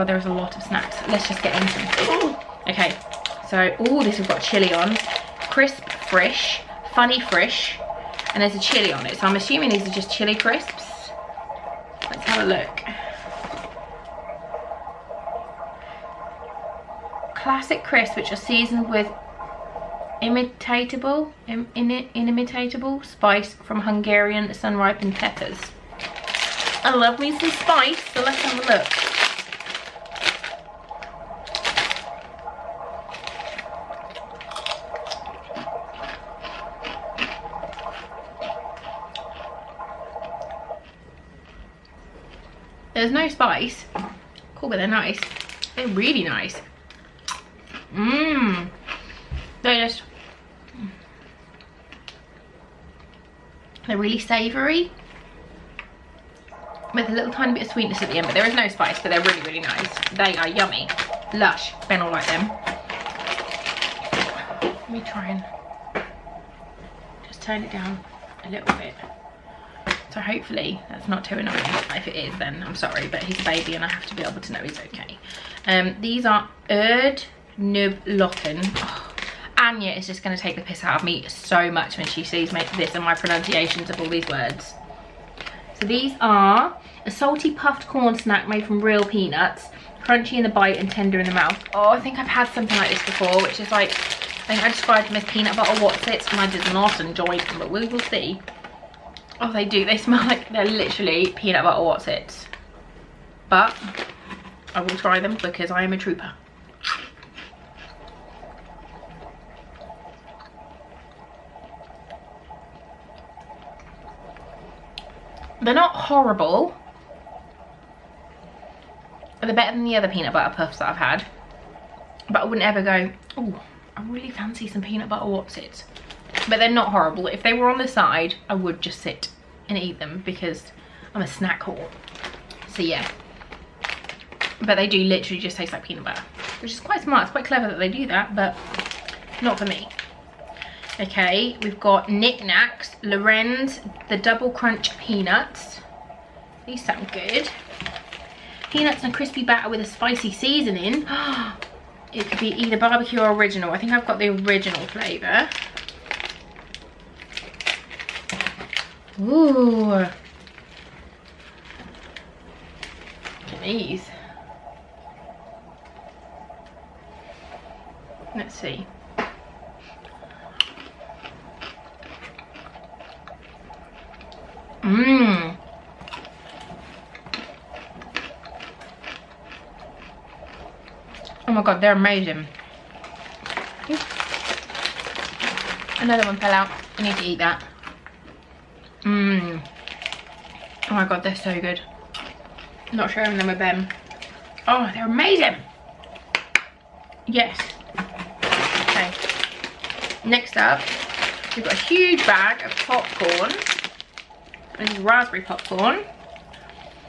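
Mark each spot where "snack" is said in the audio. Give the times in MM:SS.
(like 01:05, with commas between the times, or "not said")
00:00, 01:28, 02:11.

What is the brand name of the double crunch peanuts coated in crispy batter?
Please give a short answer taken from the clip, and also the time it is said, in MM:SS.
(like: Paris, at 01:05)
NicNac's, at 02:22.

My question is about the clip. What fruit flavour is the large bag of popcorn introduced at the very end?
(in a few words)
Raspberry.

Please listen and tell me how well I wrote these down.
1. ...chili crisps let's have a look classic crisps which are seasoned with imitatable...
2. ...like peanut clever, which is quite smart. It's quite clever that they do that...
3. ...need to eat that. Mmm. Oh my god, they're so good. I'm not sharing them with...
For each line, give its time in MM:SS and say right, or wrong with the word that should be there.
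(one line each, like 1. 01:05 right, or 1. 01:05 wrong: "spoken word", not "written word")
1. 00:10 right
2. 02:15 wrong: "butter", not "clever"
3. 03:07 right.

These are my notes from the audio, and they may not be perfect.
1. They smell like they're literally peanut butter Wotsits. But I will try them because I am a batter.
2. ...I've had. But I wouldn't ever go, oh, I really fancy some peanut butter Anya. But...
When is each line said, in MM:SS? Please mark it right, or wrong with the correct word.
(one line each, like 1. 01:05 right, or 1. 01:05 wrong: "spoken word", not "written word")
1. 01:39 wrong: "trooper", not "batter"
2. 02:00 wrong: "Wotsits", not "Anya".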